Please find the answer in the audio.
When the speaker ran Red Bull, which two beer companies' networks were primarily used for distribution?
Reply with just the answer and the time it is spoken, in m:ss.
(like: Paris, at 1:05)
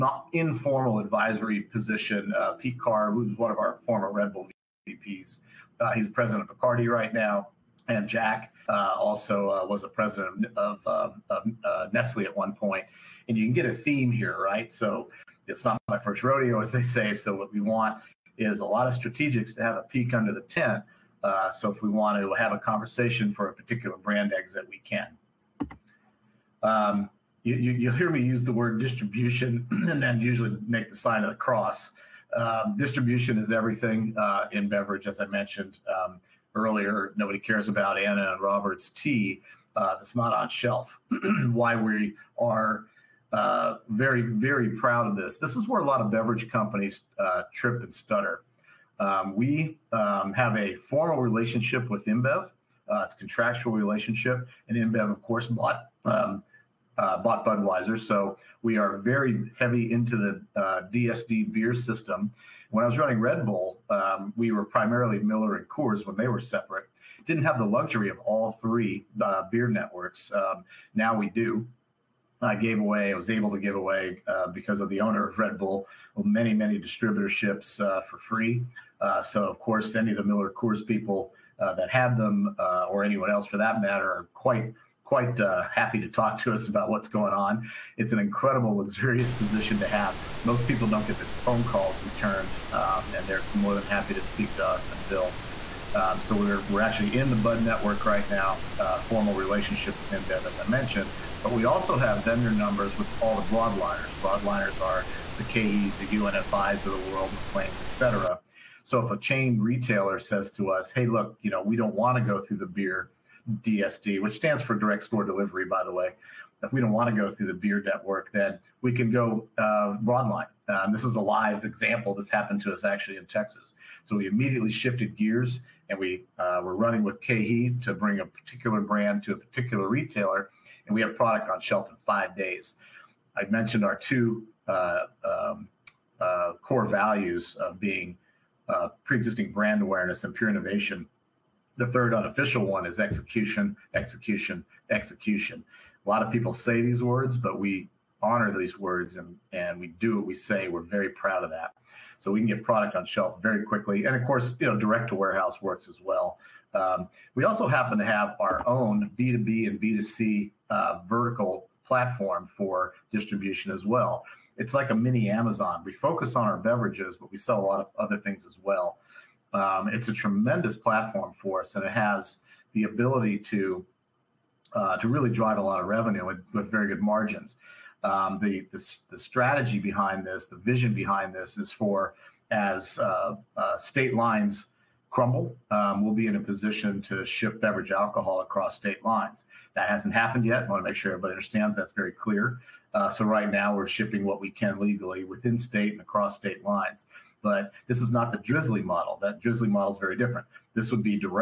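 Miller and Coors, at 1:05.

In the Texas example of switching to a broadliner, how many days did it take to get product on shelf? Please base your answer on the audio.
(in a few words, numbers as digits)
5.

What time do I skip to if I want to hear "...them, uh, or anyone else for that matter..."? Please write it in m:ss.
1:22.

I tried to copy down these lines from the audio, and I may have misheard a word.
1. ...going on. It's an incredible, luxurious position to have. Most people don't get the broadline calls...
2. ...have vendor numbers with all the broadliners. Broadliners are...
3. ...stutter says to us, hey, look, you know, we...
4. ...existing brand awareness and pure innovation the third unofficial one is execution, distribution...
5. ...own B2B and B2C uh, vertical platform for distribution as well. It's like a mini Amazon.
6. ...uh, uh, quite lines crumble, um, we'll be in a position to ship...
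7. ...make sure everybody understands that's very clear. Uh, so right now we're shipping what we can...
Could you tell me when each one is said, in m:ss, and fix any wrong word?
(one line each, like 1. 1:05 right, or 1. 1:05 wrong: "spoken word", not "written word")
1. 1:27 wrong: "phone", not "broadline"
2. 1:41 right
3. 1:49 wrong: "retailer", not "stutter"
4. 2:19 wrong: "execution", not "distribution"
5. 2:38 right
6. 3:02 wrong: "state", not "quite"
7. 3:10 right.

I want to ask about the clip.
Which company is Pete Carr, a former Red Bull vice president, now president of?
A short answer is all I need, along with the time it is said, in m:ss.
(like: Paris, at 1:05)
Bacardi, at 0:06.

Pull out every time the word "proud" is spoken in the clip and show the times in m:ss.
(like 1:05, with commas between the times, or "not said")
0:44, 2:31.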